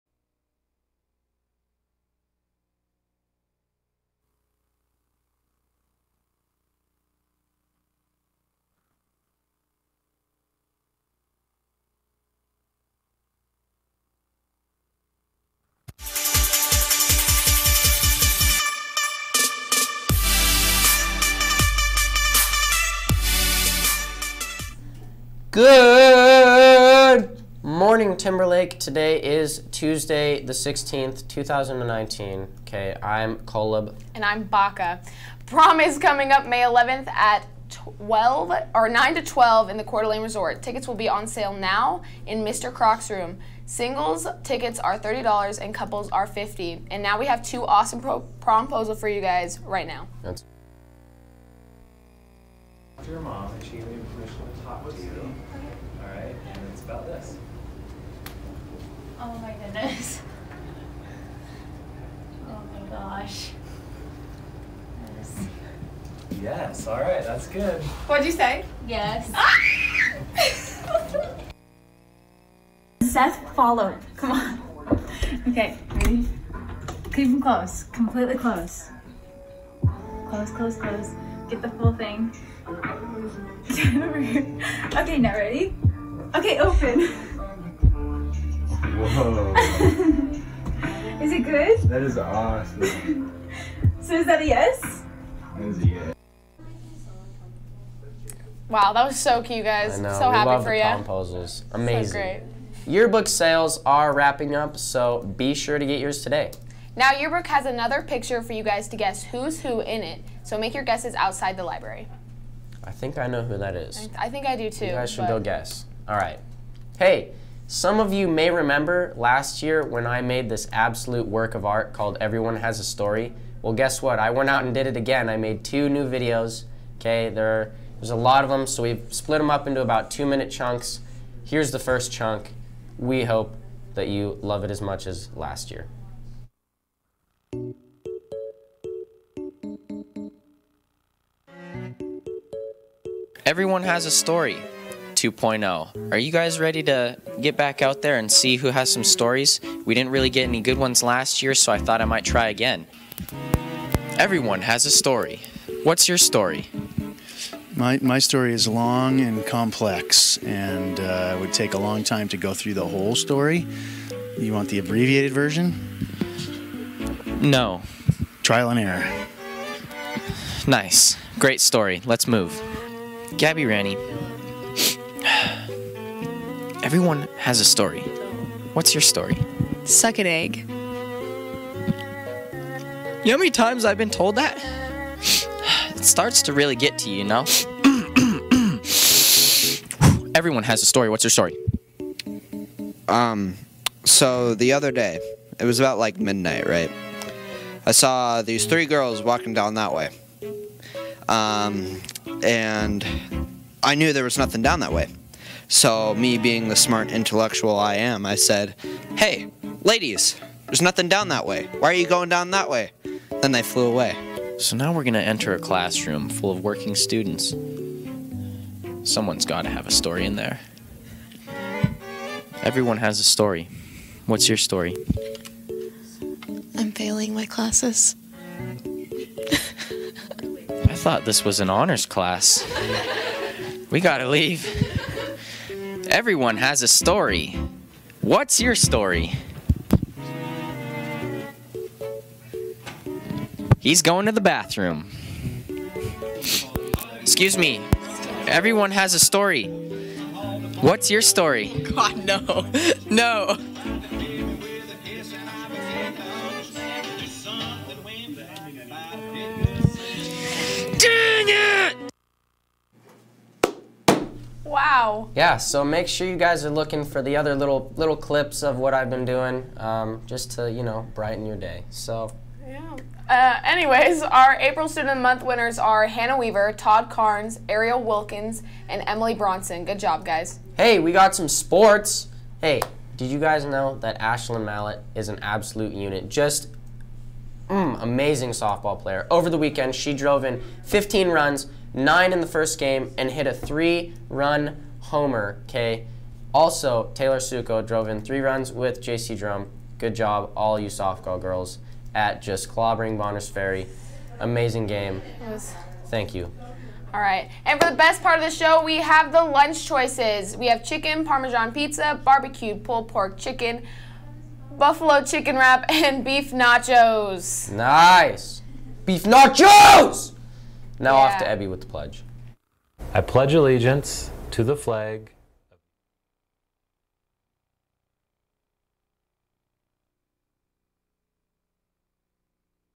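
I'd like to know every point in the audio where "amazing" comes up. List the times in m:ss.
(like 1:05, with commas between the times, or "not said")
1:41, 4:48, 5:04.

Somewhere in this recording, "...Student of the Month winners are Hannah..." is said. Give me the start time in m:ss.
4:34.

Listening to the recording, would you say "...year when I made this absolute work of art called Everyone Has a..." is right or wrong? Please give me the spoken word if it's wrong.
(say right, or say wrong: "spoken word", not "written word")
right.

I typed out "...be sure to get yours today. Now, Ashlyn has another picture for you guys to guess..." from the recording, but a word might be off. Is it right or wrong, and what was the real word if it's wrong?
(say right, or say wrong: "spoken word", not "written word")
wrong: "Yearbook", not "Ashlyn".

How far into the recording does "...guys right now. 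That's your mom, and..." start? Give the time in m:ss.
0:49.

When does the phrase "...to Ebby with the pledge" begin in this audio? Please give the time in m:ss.
5:21.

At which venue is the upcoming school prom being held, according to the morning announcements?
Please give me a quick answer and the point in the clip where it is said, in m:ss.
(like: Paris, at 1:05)
Coeur d'Alene Resort, at 0:39.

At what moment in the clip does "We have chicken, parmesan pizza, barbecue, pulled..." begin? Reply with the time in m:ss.
5:10.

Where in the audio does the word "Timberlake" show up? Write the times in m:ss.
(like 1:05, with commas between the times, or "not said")
0:28.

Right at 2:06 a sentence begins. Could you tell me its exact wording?
Okay, there, there's a lot of them, so we've split them up into about two minute chunks.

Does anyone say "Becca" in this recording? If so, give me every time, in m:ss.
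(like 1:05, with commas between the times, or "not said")
0:34.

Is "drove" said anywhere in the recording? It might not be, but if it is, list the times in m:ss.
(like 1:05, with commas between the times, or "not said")
4:50, 4:57.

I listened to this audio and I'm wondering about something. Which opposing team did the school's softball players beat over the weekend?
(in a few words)
Bonners Ferry.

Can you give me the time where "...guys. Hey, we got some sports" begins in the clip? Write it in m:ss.
4:40.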